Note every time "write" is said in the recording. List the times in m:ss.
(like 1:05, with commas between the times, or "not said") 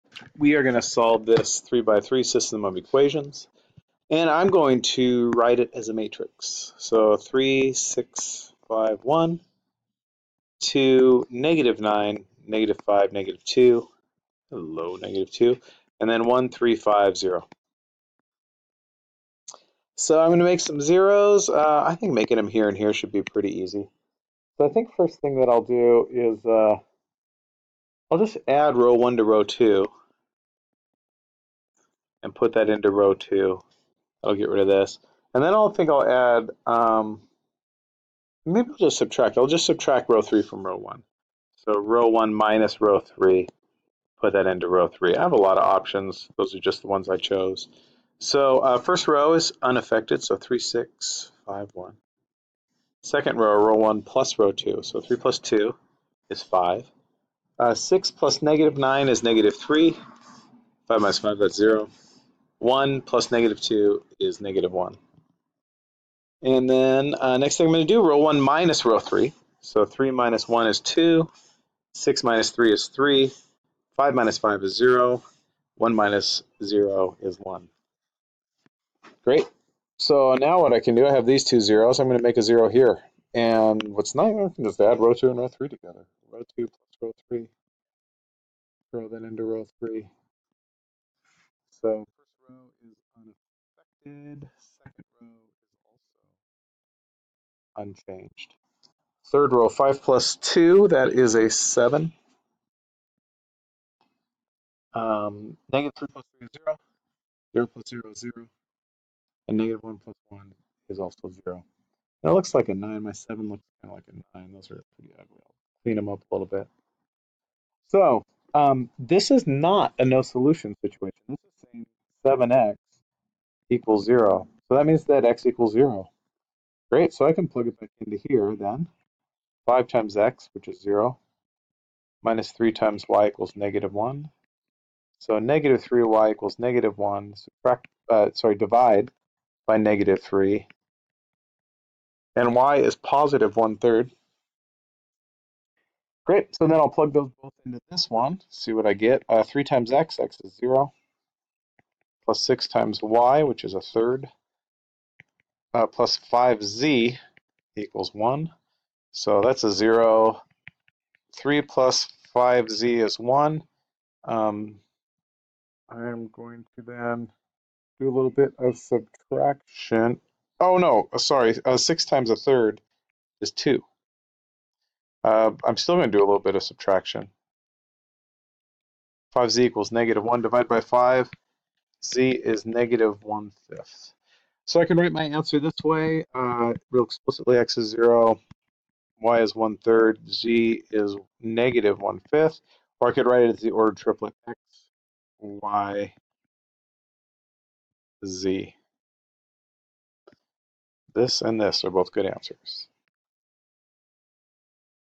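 0:05, 3:04, 3:13.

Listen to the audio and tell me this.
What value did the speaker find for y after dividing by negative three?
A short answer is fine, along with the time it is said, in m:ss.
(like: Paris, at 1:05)
1/3, at 2:22.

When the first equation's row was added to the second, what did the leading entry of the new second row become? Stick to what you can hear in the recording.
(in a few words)
5.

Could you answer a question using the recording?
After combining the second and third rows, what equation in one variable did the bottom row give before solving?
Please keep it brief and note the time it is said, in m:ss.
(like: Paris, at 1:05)
7x = 0, at 2:02.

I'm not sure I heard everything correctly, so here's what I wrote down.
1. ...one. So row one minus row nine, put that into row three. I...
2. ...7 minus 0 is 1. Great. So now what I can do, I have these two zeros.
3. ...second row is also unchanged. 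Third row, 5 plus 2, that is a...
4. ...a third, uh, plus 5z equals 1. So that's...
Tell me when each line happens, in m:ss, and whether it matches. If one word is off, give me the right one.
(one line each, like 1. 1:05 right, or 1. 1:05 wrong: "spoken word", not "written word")
1. 0:40 wrong: "three", not "nine"
2. 1:15 wrong: "1", not "7"
3. 1:34 right
4. 2:33 right.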